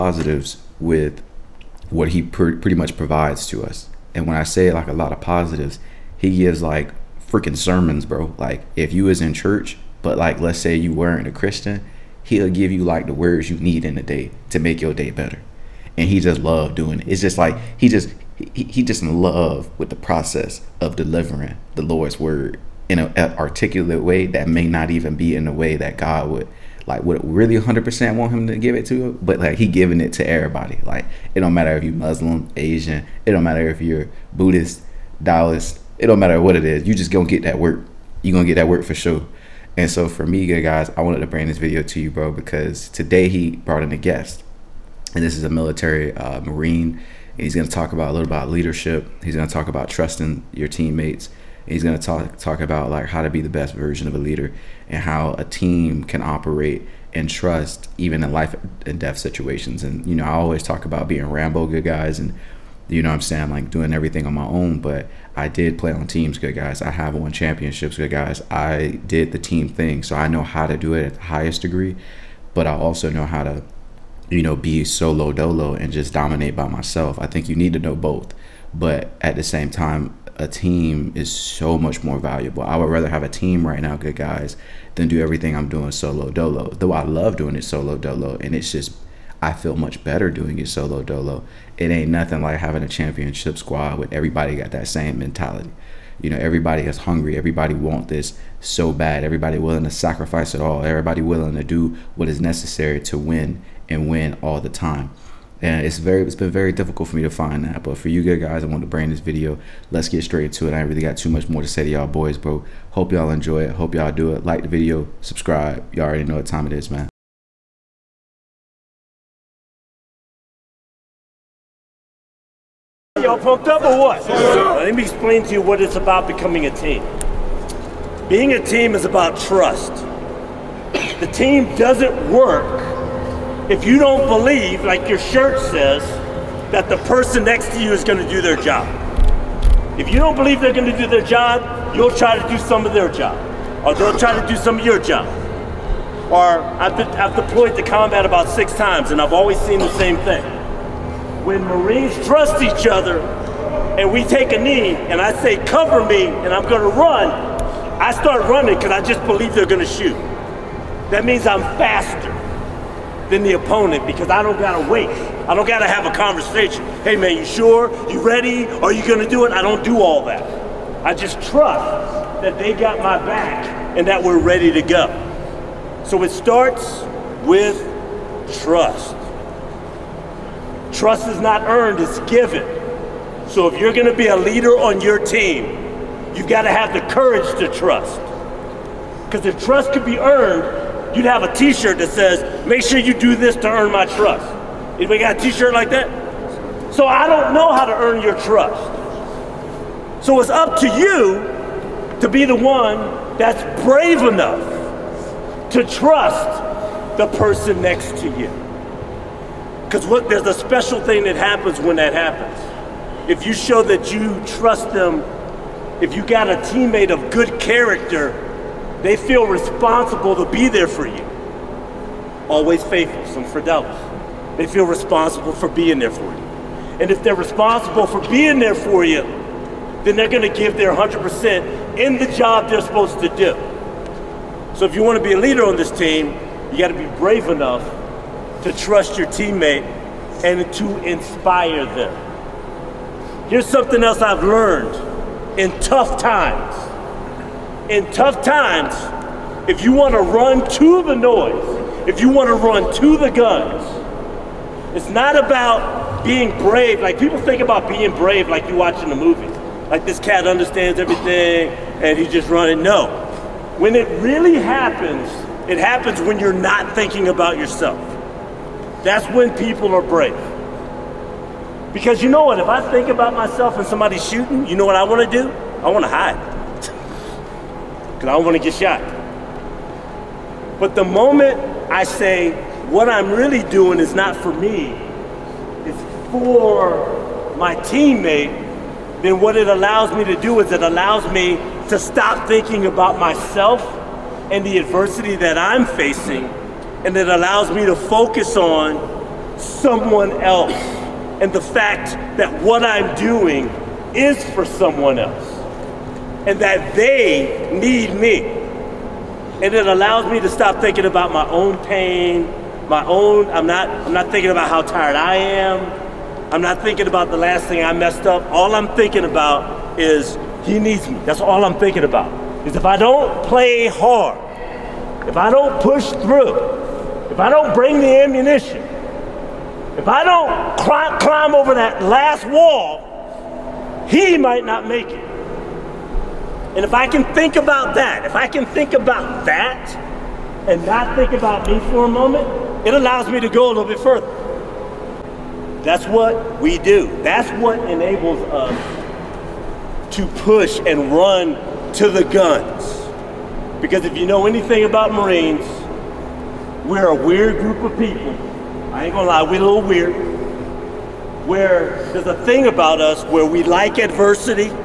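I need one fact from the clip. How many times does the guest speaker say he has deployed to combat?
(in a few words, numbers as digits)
6.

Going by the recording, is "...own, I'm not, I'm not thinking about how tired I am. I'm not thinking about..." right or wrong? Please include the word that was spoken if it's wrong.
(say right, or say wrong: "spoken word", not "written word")
right.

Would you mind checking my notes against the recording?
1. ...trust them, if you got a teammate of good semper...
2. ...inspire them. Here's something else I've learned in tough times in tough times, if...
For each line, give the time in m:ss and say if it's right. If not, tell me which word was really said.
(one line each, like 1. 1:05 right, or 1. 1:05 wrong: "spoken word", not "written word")
1. 3:34 wrong: "character", not "semper"
2. 4:01 right.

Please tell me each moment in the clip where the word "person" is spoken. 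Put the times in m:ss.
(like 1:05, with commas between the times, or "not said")
2:16, 3:27.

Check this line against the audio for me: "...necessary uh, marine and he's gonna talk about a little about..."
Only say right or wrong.
wrong.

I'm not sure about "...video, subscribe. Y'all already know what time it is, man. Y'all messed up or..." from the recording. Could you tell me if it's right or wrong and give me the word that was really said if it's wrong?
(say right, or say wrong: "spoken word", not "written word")
wrong: "pumped", not "messed".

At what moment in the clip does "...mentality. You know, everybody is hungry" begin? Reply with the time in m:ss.
1:35.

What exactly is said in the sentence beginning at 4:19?
Like this cat understands everything and he's just running.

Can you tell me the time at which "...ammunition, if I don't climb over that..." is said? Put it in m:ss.
5:28.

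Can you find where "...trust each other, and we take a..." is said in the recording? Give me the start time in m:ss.
2:32.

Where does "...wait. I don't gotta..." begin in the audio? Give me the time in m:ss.
2:44.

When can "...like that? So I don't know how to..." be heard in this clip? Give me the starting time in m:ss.
3:15.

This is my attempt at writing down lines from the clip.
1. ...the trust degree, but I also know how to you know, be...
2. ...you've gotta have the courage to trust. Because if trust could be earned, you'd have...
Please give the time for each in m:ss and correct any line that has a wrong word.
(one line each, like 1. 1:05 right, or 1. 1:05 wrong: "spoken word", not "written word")
1. 1:11 wrong: "highest", not "trust"
2. 3:06 right.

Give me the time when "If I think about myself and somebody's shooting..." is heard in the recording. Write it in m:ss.
4:32.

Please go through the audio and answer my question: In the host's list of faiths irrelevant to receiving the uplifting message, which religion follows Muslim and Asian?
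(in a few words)
Buddhist.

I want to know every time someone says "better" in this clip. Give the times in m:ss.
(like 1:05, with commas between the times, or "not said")
0:15, 1:30.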